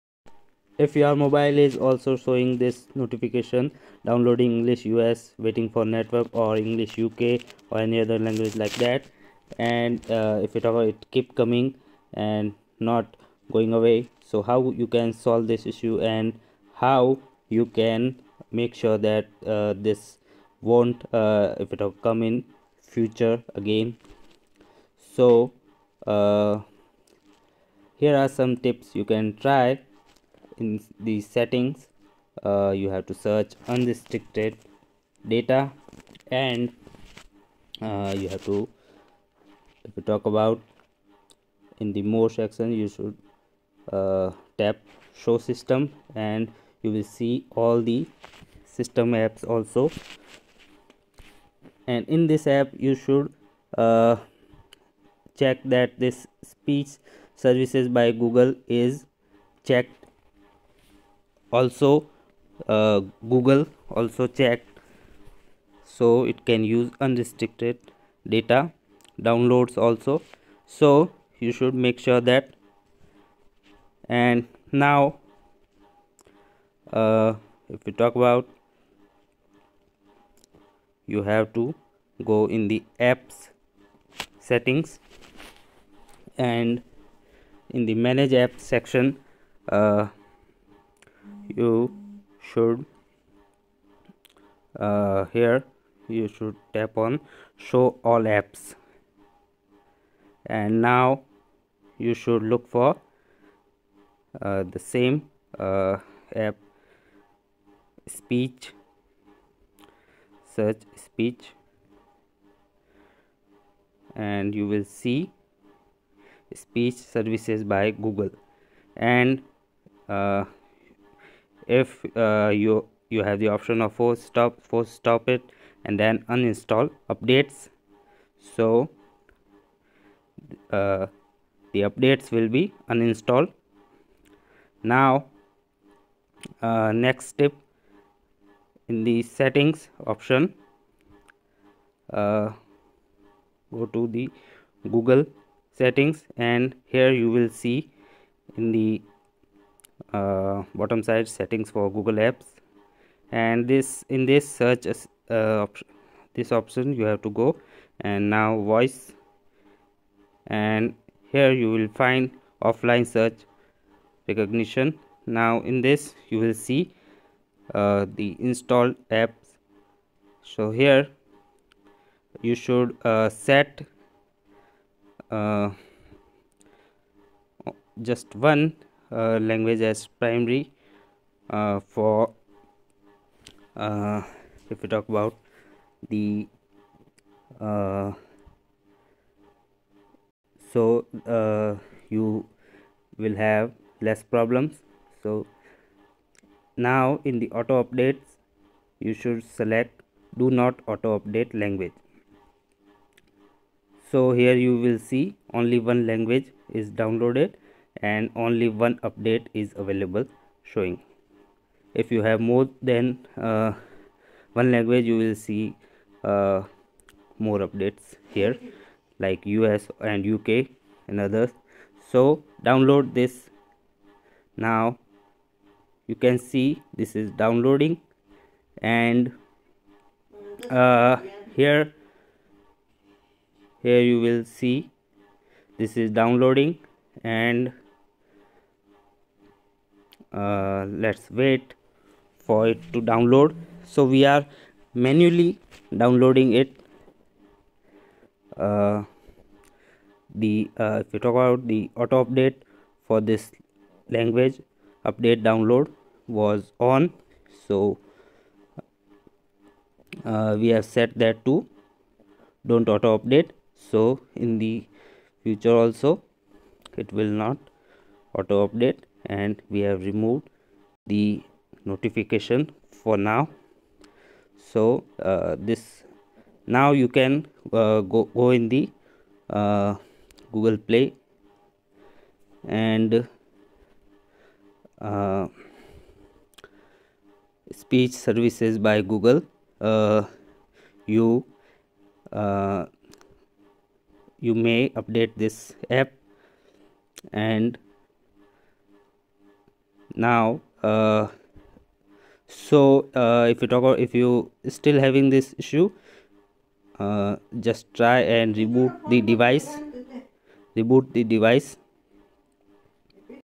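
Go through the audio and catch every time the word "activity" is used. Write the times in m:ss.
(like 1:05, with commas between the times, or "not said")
not said.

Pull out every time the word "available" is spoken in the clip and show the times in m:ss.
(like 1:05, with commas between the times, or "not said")
3:29.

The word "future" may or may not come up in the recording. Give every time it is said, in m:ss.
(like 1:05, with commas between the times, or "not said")
0:22, 4:25.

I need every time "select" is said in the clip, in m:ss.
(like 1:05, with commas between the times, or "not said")
3:19.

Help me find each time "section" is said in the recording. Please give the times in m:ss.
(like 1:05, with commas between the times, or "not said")
0:42, 1:28.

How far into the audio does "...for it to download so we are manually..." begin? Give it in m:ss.
4:02.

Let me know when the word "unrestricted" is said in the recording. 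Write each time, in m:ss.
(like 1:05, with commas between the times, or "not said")
0:33, 1:07.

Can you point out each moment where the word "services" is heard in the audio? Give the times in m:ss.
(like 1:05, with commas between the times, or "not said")
0:57, 1:56, 4:48.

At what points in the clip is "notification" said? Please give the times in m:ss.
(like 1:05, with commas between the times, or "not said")
0:02, 4:31.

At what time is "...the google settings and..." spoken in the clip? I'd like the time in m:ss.
2:24.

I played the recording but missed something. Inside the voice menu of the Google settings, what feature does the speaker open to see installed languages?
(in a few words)
offline search recognition.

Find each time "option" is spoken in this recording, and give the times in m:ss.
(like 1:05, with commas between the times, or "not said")
2:03, 2:20, 2:36.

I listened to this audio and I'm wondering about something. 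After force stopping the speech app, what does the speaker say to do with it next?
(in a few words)
uninstall updates.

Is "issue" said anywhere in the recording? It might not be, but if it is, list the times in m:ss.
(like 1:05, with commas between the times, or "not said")
0:15, 5:05.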